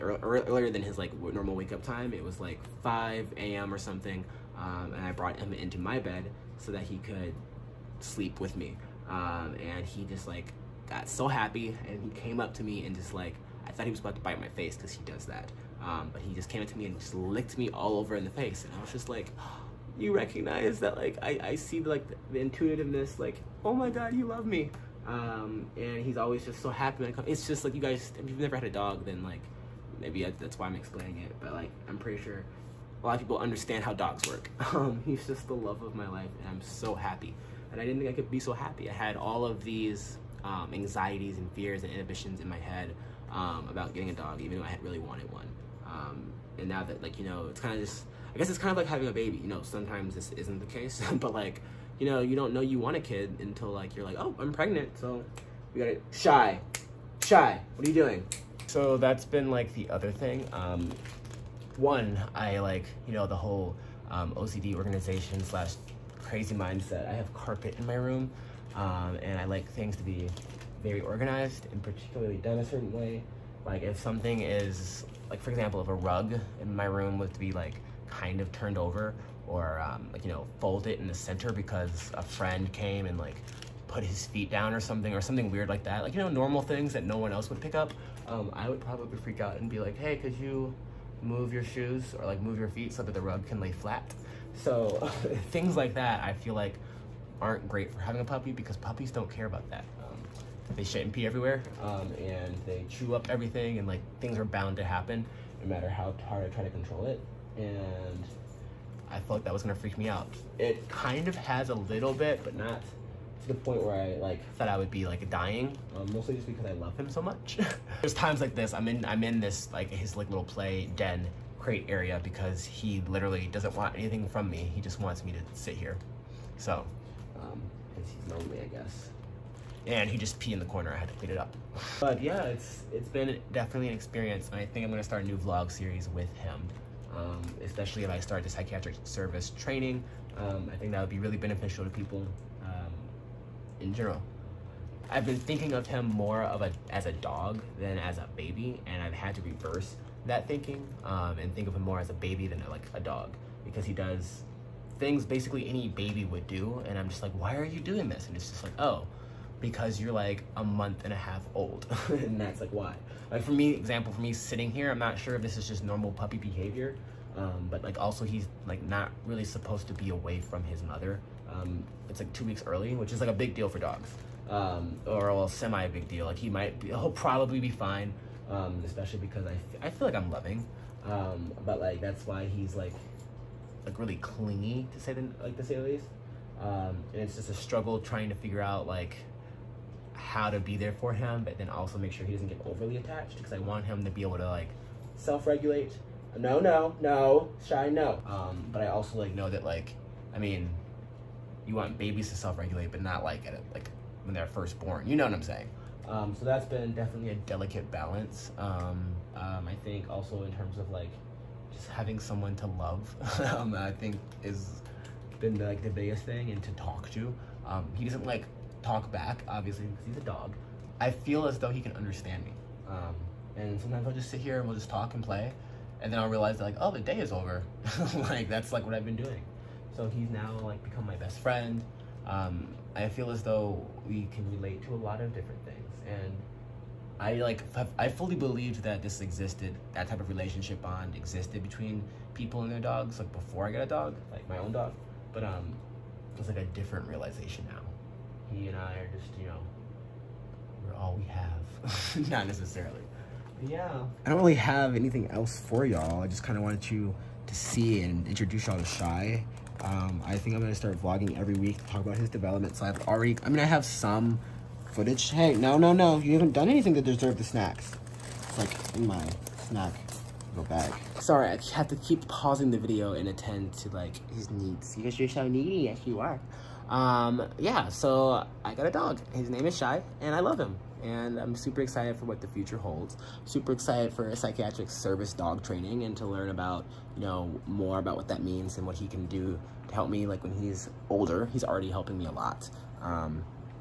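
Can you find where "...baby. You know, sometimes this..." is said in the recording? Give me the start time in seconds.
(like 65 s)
49 s.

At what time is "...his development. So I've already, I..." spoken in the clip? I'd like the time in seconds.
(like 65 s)
262 s.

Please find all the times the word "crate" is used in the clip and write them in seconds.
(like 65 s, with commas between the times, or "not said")
121 s.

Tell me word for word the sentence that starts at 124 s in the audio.
He just wants me to sit here.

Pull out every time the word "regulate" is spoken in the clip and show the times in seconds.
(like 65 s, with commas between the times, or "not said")
195 s, 202 s.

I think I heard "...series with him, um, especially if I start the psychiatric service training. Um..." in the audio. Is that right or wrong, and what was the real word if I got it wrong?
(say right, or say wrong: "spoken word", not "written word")
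right.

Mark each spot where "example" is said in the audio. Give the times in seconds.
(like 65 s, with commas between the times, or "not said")
75 s, 163 s.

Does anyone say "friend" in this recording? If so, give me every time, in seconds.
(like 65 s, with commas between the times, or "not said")
82 s, 231 s.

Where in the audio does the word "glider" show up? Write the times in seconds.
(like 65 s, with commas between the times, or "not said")
not said.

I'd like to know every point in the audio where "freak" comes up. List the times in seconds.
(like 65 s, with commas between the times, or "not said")
89 s, 109 s.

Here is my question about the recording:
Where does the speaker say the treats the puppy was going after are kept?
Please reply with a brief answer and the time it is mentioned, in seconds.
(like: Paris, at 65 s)
Snack go bag, at 269 s.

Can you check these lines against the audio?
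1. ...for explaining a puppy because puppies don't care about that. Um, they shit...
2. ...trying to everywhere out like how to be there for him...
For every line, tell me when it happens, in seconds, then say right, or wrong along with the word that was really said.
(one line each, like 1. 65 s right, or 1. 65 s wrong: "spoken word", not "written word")
1. 97 s wrong: "having", not "explaining"
2. 187 s wrong: "figure", not "everywhere".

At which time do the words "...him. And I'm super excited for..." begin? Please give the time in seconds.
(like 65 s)
280 s.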